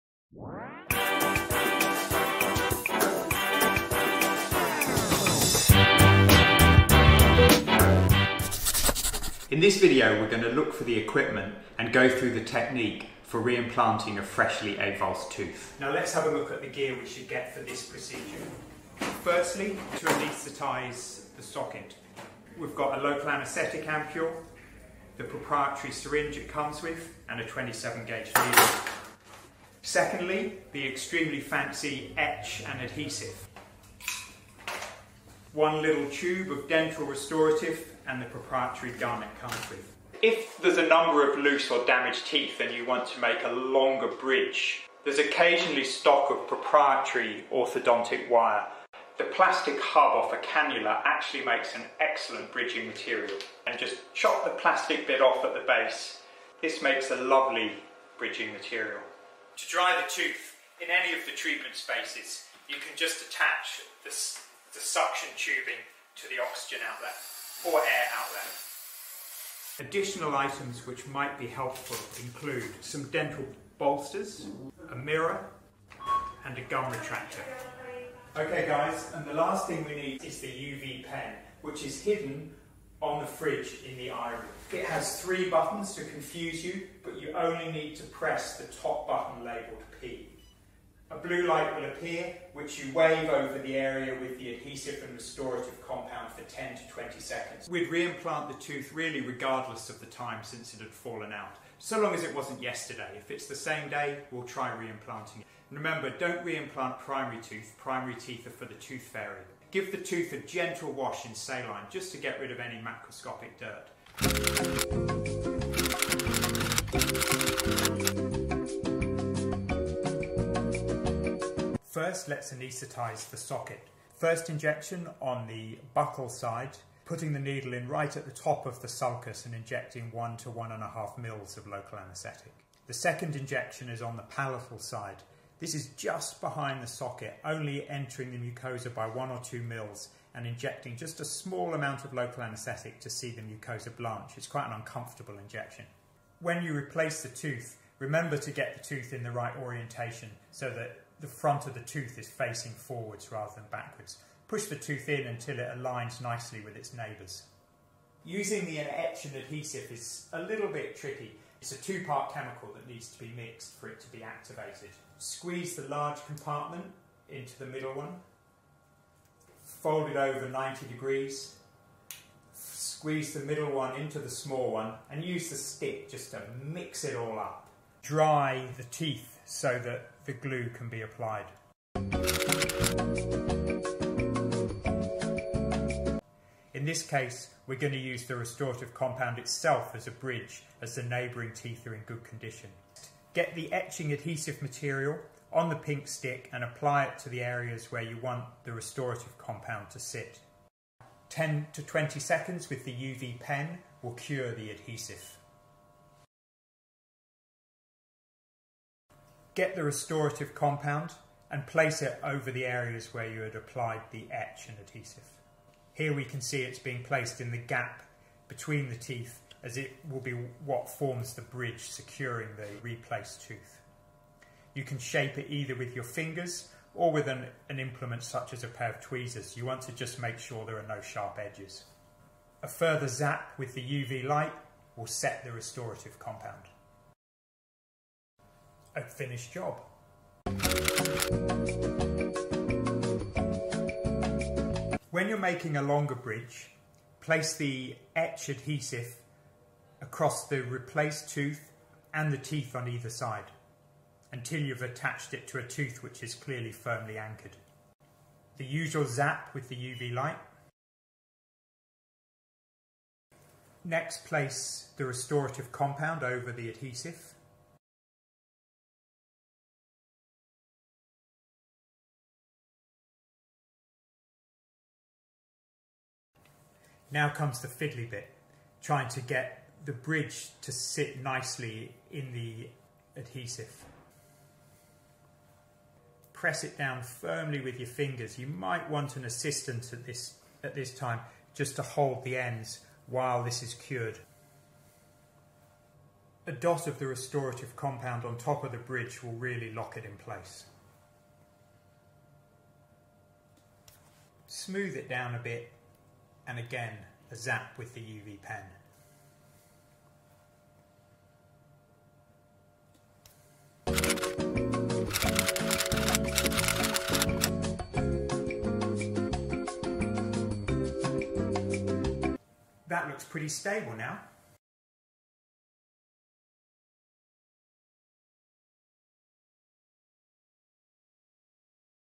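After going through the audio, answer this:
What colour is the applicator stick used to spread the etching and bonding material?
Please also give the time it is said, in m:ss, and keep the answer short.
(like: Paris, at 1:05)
pink, at 3:15.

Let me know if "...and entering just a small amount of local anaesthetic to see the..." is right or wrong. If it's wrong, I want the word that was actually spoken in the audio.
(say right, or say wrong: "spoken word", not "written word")
wrong: "injecting", not "entering".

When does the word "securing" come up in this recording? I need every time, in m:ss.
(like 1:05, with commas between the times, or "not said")
3:41.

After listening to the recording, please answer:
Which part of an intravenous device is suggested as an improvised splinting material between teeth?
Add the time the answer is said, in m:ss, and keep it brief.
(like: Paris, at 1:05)
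plastic hub, at 0:49.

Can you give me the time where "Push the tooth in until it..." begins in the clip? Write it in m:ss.
2:34.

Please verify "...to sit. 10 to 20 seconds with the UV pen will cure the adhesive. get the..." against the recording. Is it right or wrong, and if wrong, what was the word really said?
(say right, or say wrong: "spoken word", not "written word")
right.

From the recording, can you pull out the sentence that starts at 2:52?
Squeeze the middle one into the small one and use the stick just to mix it all up.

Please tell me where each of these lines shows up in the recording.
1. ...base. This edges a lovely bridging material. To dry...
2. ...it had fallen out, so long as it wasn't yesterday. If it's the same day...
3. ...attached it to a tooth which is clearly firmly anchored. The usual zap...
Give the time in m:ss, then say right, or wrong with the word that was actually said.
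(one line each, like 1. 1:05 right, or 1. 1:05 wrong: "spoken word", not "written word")
1. 0:55 wrong: "makes", not "edges"
2. 1:40 right
3. 4:14 right.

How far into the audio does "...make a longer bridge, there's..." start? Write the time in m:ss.
0:43.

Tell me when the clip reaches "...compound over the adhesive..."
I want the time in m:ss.
4:25.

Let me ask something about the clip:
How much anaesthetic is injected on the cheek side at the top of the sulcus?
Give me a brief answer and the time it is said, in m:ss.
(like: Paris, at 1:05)
1 to 1.5 ml, at 2:10.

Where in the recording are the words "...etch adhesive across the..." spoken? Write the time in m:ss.
4:08.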